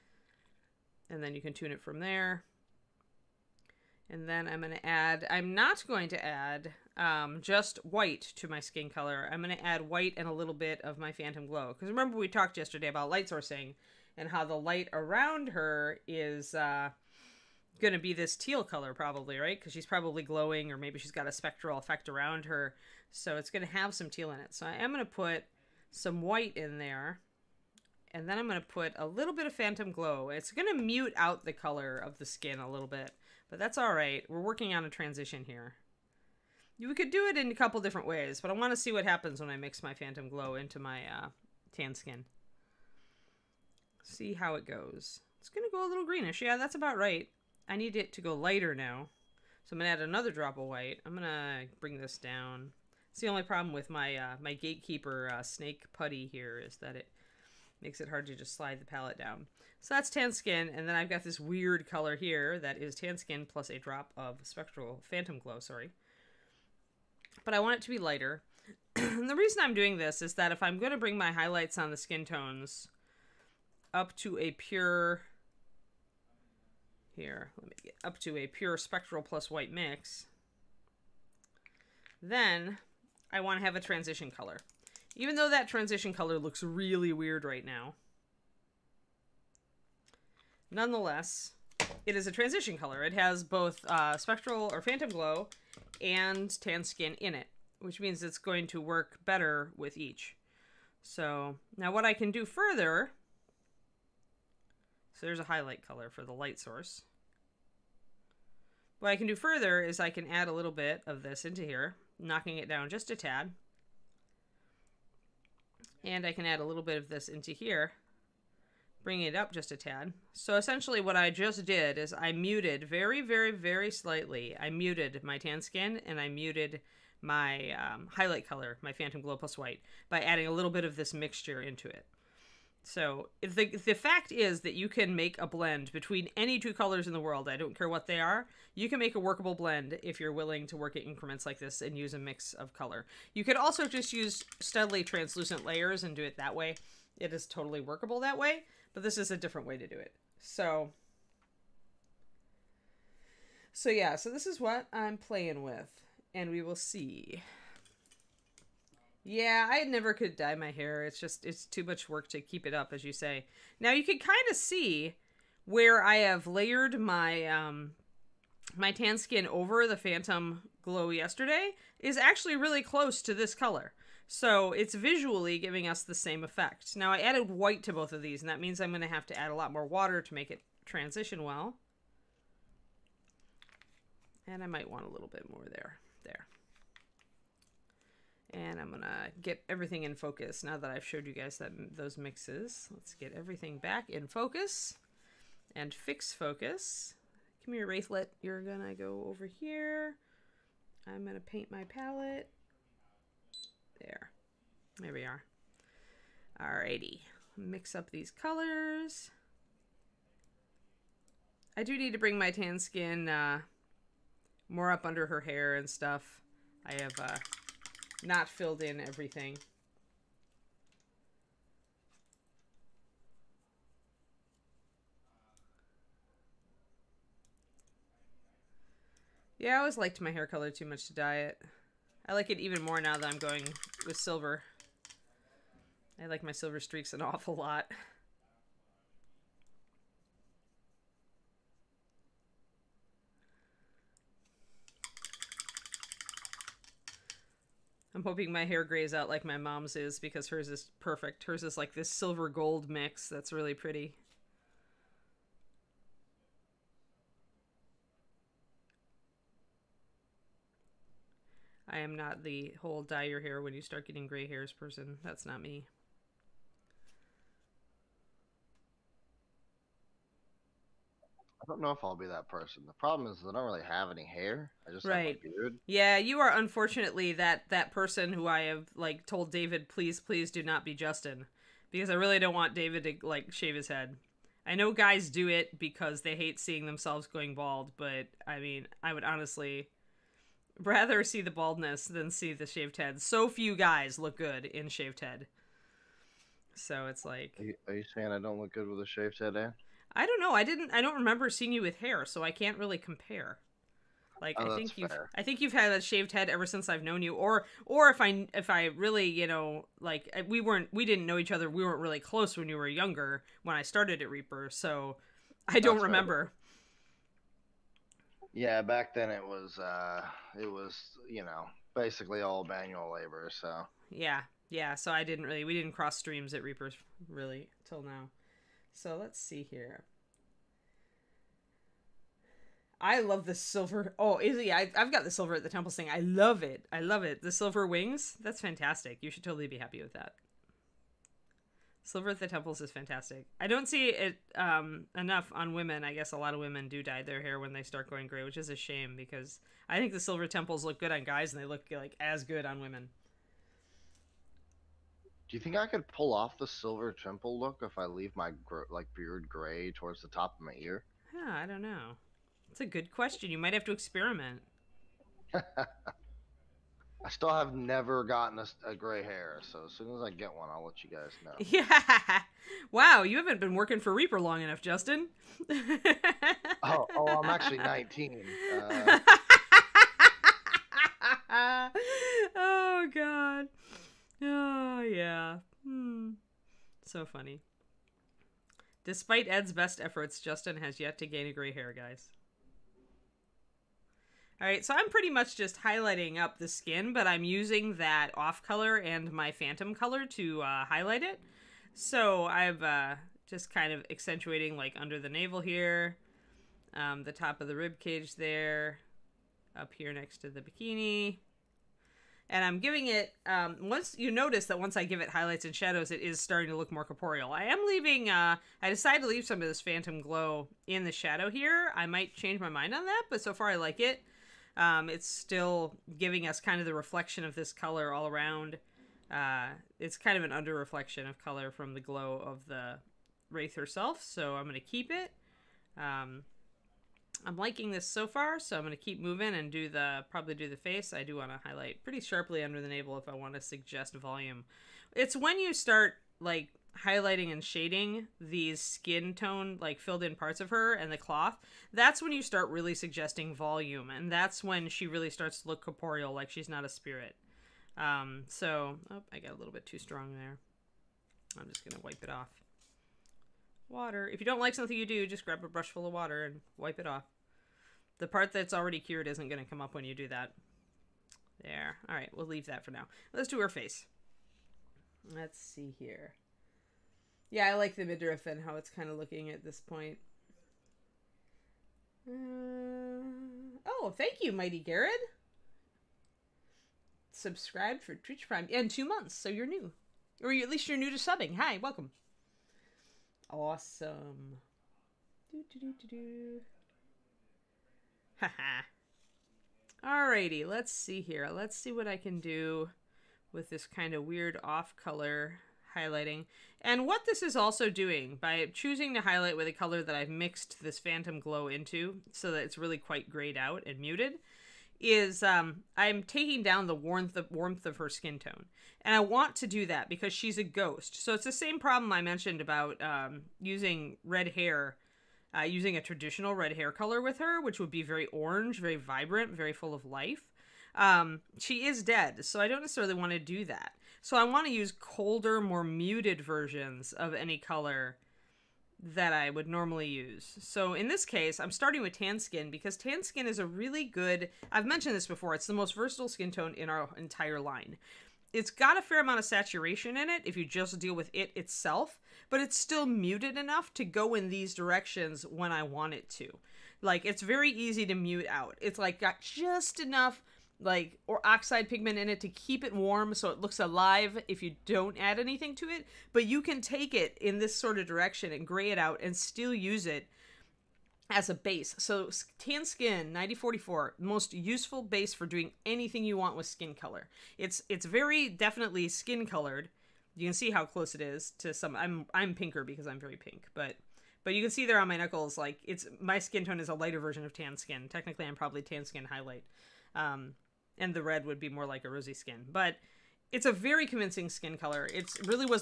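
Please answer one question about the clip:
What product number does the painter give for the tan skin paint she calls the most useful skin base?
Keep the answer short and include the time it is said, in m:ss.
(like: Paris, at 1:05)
9044, at 9:33.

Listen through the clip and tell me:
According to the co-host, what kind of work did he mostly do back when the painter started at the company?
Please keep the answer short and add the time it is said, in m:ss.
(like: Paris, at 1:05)
manual labor, at 5:22.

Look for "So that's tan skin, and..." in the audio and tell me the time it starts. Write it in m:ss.
0:59.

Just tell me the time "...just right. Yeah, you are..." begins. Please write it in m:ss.
4:34.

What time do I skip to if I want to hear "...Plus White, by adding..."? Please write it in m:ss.
2:09.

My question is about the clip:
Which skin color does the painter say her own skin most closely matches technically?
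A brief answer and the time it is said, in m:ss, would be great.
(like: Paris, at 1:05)
tan skin highlight, at 9:48.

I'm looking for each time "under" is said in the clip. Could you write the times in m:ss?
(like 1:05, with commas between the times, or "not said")
3:35, 6:44, 7:10, 7:22.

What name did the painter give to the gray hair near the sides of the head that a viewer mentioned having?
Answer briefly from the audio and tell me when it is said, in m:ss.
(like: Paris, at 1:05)
silver wings, at 5:37.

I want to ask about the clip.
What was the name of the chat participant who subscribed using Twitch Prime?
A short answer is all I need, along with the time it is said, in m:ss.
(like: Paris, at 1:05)
Mighty Garrett, at 8:04.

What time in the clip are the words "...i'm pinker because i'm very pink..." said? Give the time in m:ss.
9:42.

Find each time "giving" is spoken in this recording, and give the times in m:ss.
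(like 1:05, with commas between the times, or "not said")
2:55, 6:52, 7:06.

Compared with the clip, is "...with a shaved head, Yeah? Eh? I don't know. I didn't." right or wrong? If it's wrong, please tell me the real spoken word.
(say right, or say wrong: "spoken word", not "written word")
wrong: "Anne", not "Yeah".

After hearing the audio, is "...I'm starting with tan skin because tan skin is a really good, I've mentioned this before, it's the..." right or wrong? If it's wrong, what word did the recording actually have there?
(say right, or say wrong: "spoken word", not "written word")
right.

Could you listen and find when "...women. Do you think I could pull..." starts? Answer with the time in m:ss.
5:52.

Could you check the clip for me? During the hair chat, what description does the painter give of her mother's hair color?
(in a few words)
silver gold mix.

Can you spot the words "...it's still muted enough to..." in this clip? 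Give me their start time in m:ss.
9:12.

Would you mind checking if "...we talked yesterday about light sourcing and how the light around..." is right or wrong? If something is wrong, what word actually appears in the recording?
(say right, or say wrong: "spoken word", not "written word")
right.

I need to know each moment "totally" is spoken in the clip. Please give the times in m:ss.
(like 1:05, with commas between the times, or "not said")
2:27, 5:39.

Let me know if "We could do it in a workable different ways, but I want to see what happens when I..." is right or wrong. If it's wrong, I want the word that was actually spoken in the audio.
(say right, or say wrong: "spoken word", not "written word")
wrong: "couple", not "workable".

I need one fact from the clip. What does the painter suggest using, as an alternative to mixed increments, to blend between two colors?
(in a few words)
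translucent layers.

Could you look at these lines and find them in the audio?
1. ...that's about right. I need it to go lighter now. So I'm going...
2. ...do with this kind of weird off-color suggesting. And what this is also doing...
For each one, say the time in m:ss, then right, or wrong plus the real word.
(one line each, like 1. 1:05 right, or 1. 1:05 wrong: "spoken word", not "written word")
1. 0:46 right
2. 8:22 wrong: "highlighting", not "suggesting".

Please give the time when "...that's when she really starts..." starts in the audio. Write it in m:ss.
7:34.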